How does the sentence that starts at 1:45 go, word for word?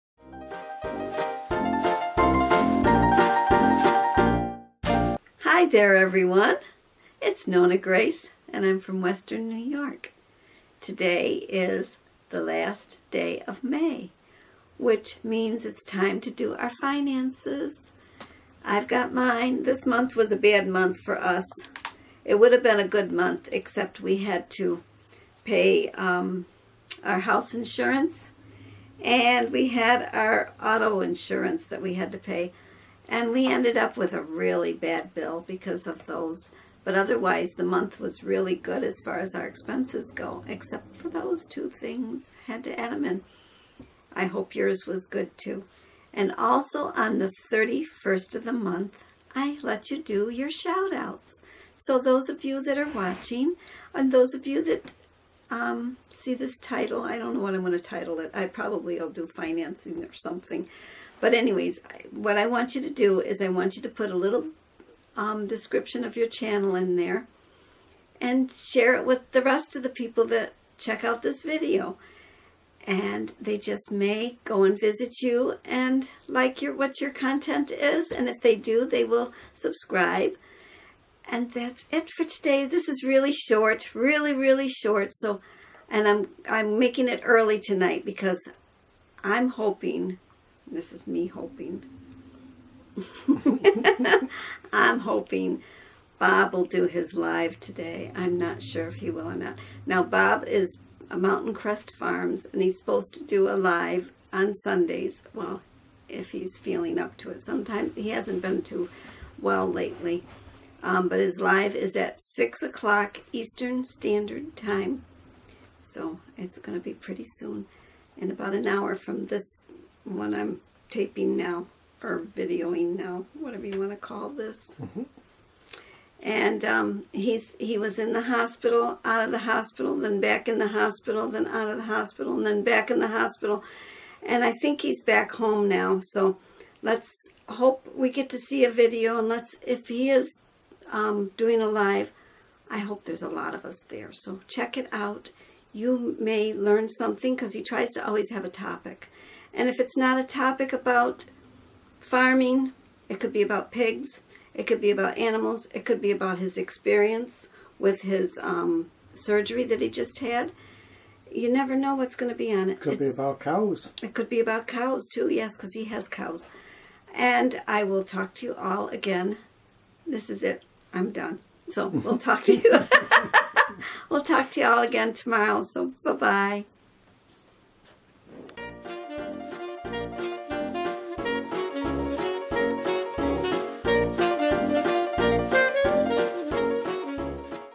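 Well, if he's feeling up to it.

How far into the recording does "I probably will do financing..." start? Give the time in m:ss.
0:58.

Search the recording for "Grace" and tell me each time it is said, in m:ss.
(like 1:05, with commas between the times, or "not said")
0:07.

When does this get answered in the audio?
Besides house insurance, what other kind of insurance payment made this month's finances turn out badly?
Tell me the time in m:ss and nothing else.
0:30.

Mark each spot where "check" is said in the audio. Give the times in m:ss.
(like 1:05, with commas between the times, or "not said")
1:10, 2:24.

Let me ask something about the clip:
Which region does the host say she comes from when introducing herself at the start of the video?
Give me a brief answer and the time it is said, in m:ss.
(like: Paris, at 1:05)
Western New York, at 0:08.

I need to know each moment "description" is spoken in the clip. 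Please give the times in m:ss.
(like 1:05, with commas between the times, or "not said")
1:05.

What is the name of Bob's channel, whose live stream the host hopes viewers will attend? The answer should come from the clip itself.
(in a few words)
Mountain Crest Farms.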